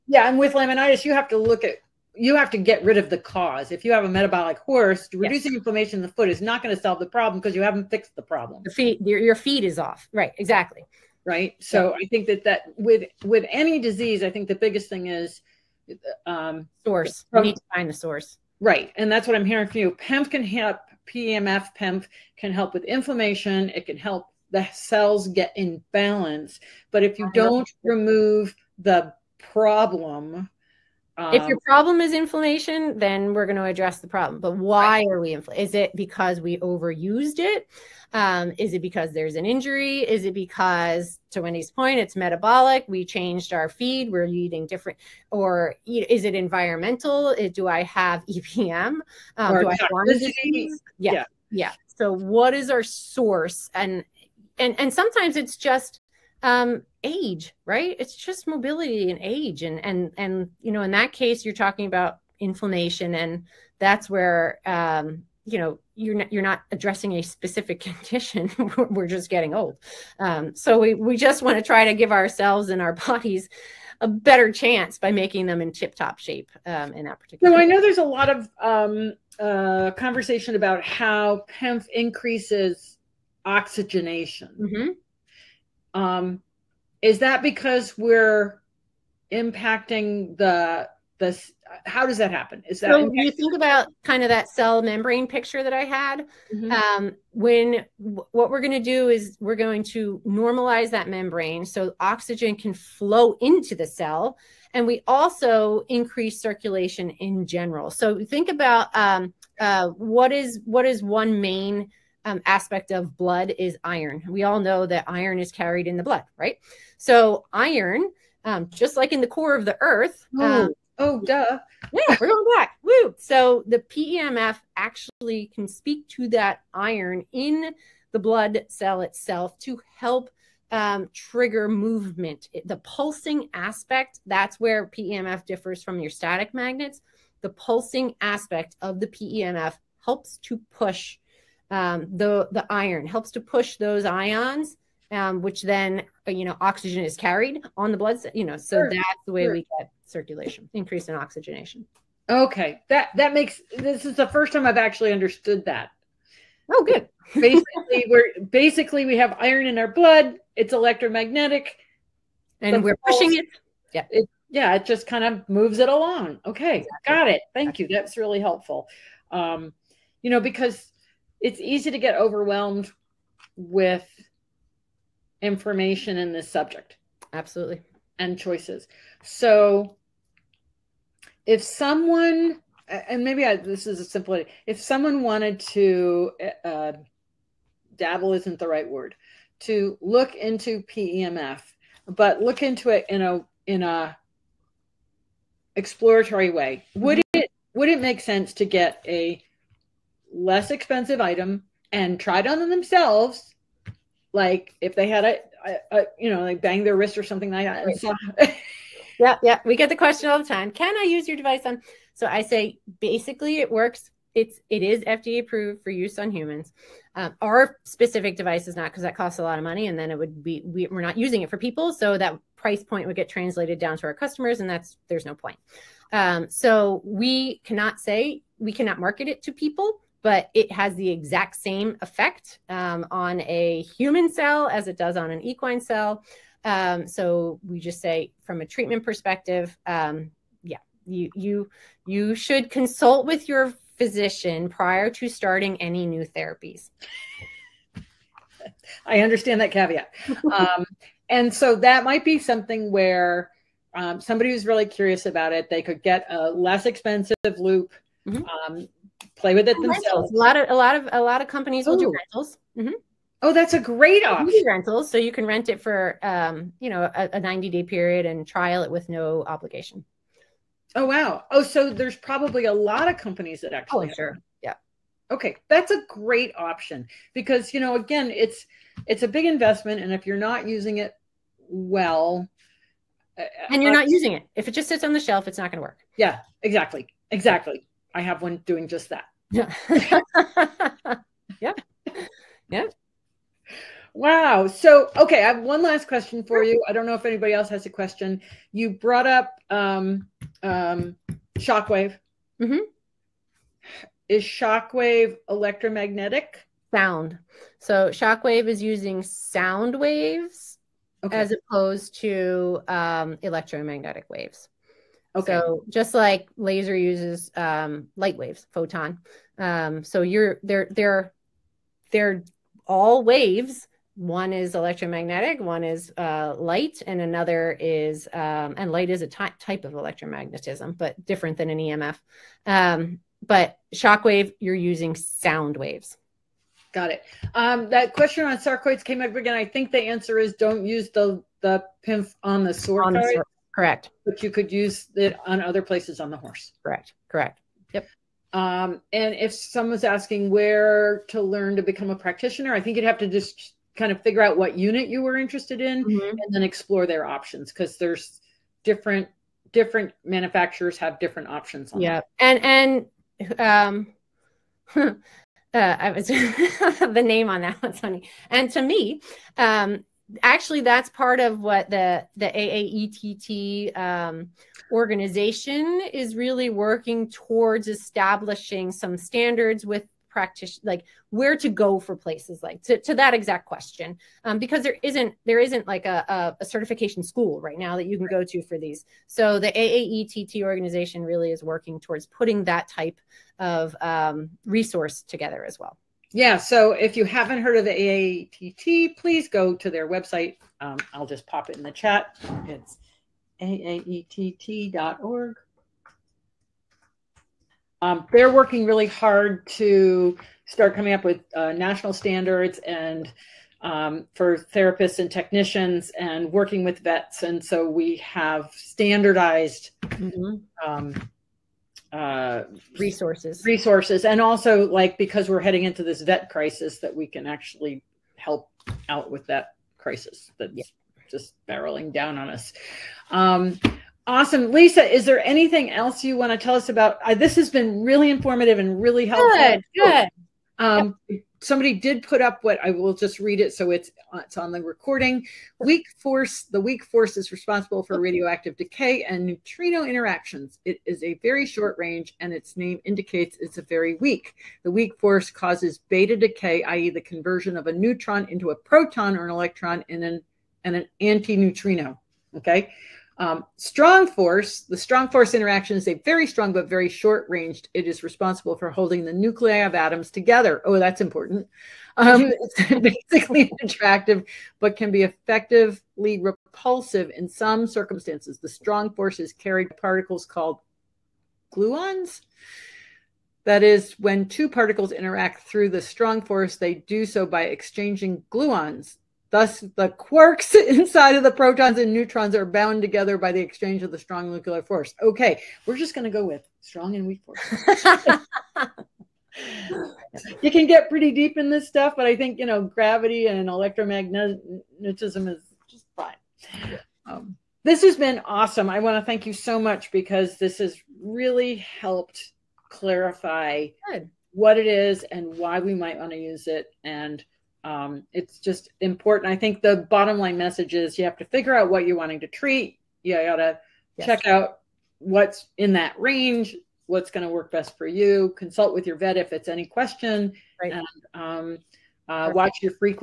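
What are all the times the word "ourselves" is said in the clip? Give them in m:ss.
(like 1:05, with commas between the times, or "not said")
1:12.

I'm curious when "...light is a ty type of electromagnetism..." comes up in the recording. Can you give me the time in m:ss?
5:28.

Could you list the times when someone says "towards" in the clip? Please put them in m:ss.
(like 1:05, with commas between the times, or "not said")
6:17, 6:32.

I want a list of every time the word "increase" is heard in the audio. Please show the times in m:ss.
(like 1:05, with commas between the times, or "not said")
1:21, 1:45, 2:30.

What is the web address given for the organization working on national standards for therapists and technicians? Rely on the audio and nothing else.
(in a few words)
aaett.org.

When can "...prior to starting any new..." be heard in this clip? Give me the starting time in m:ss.
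4:04.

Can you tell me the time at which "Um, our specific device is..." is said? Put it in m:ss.
3:37.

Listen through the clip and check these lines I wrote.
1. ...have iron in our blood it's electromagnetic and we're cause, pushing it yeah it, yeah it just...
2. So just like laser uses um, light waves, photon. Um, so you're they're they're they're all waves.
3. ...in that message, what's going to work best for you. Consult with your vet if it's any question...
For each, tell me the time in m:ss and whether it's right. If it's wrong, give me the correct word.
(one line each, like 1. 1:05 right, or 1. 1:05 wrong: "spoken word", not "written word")
1. 2:39 wrong: "pulse", not "cause"
2. 5:15 right
3. 8:45 wrong: "range", not "message".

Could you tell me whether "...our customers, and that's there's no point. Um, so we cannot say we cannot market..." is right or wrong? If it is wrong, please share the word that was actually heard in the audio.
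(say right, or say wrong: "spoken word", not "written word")
right.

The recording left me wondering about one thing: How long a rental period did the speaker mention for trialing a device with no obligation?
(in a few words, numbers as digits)
90 days.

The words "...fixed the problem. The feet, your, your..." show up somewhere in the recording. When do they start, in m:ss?
0:07.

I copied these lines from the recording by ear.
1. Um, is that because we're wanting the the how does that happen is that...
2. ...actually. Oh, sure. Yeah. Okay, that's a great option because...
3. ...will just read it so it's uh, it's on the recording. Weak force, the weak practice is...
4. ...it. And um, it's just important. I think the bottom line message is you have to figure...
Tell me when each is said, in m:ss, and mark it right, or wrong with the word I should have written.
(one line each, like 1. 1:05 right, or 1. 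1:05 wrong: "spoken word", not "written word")
1. 1:26 wrong: "impacting", not "wanting"
2. 4:33 right
3. 7:22 wrong: "force", not "practice"
4. 8:36 right.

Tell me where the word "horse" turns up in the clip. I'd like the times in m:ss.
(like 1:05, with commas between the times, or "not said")
0:04, 5:46.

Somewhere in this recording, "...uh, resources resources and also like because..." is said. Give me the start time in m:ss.
7:02.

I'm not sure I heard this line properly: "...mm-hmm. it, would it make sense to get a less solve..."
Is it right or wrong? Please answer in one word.
wrong.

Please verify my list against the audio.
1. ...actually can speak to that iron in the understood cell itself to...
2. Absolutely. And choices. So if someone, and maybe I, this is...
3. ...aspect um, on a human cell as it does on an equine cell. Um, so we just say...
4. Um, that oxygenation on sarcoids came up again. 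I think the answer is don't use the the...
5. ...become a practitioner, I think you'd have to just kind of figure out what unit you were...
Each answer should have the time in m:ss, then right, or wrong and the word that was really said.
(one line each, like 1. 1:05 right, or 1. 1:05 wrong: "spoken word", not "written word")
1. 2:04 wrong: "blood", not "understood"
2. 2:57 right
3. 3:52 wrong: "effect", not "aspect"
4. 5:37 wrong: "question", not "oxygenation"
5. 5:51 right.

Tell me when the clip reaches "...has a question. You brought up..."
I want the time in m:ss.
4:57.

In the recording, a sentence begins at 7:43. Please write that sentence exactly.
Um, strong force, the strong force interaction is a very strong but very short ranged.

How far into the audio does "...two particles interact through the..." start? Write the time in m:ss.
8:04.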